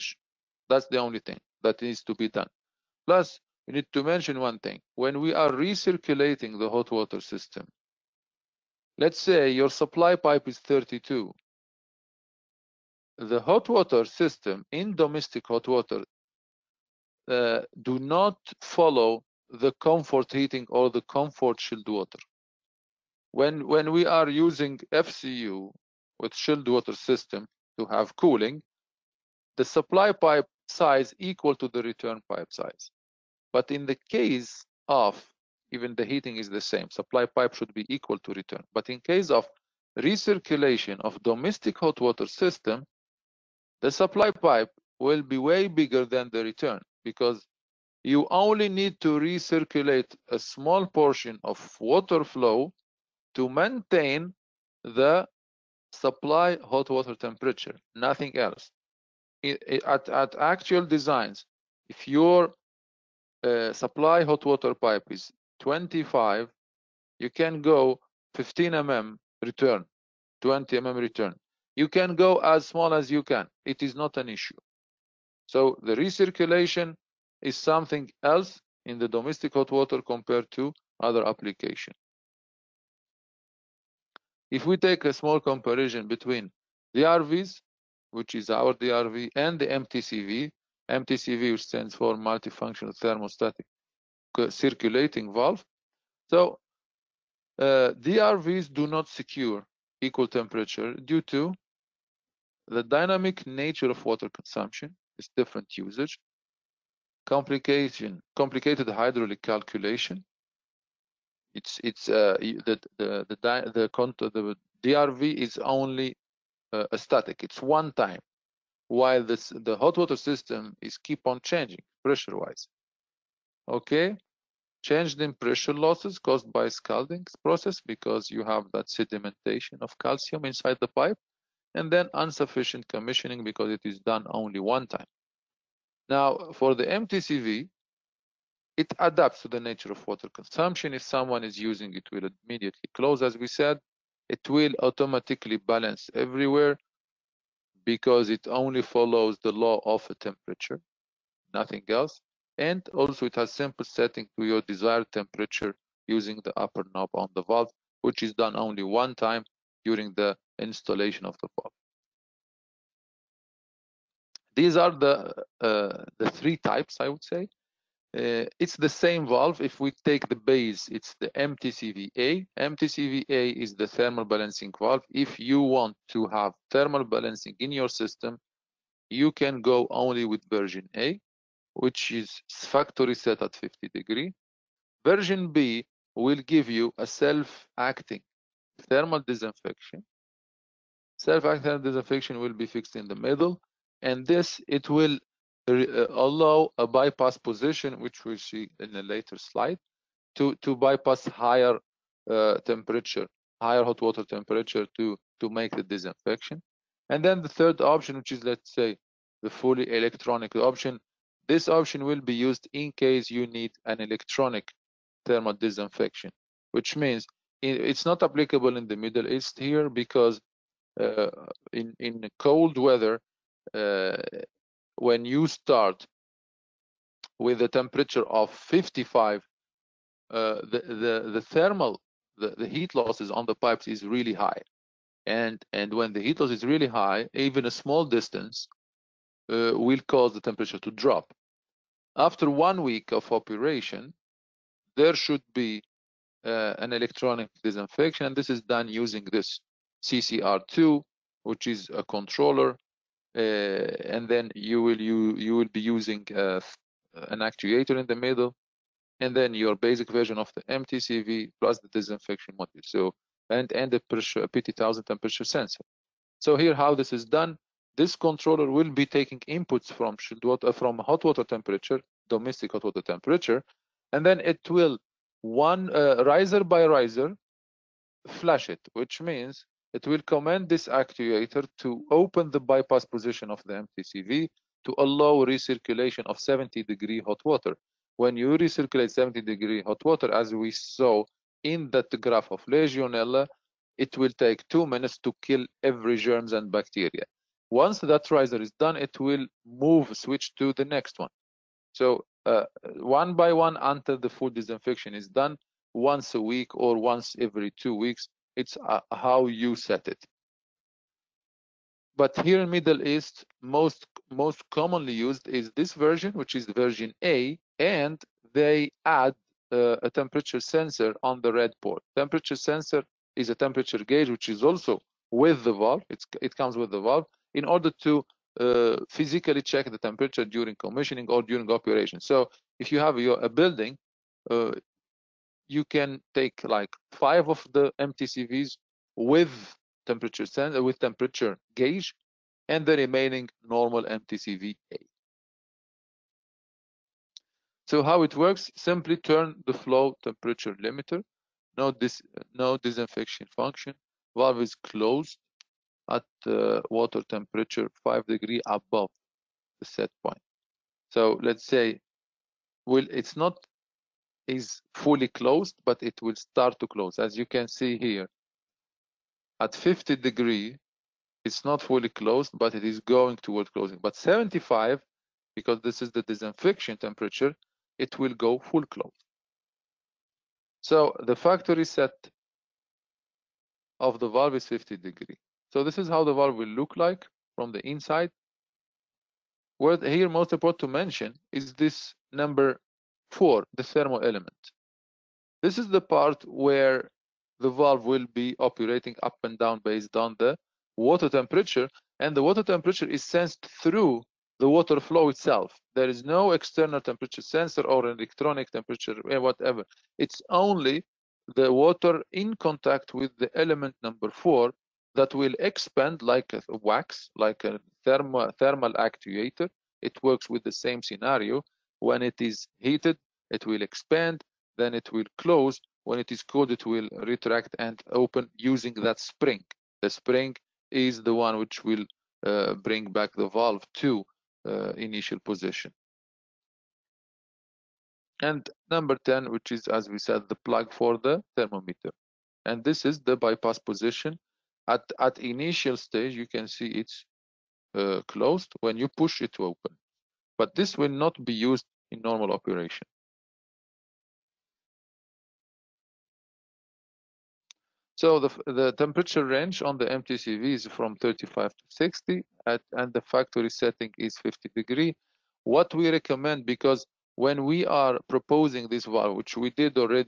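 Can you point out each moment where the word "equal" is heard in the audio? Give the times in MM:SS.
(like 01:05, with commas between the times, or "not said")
00:31, 00:37, 01:39.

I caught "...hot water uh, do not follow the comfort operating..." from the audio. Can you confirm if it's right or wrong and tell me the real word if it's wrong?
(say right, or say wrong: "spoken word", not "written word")
wrong: "heating", not "operating".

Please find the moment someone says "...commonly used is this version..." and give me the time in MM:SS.
05:14.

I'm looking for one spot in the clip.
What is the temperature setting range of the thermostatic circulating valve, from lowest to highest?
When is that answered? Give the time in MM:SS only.
07:41.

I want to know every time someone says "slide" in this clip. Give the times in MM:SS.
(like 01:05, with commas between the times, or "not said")
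03:19.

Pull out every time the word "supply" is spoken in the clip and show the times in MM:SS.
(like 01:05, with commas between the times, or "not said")
00:09, 00:29, 00:36, 00:43, 00:55, 01:03.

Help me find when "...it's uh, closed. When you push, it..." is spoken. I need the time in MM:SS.
07:26.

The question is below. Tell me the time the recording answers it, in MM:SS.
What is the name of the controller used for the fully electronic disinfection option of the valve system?
04:10.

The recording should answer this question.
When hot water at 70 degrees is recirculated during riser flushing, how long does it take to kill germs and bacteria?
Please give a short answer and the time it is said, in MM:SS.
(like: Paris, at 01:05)
2 minutes, at 04:54.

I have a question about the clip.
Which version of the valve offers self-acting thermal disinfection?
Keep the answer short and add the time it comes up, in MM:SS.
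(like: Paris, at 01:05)
Version B, at 03:05.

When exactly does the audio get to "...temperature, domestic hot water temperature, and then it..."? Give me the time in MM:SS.
04:31.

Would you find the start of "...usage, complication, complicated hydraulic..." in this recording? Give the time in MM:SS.
01:45.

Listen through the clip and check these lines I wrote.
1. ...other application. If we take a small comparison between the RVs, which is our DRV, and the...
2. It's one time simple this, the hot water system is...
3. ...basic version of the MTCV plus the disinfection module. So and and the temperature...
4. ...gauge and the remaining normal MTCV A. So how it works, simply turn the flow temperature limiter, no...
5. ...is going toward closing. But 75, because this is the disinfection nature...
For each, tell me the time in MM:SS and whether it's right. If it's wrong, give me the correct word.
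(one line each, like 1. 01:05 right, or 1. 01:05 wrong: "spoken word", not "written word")
1. 01:20 right
2. 01:57 wrong: "while", not "simple"
3. 04:19 wrong: "pressure", not "temperature"
4. 05:41 right
5. 06:12 wrong: "temperature", not "nature".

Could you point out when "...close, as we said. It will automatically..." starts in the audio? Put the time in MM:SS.
02:22.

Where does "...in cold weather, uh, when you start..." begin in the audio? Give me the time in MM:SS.
03:41.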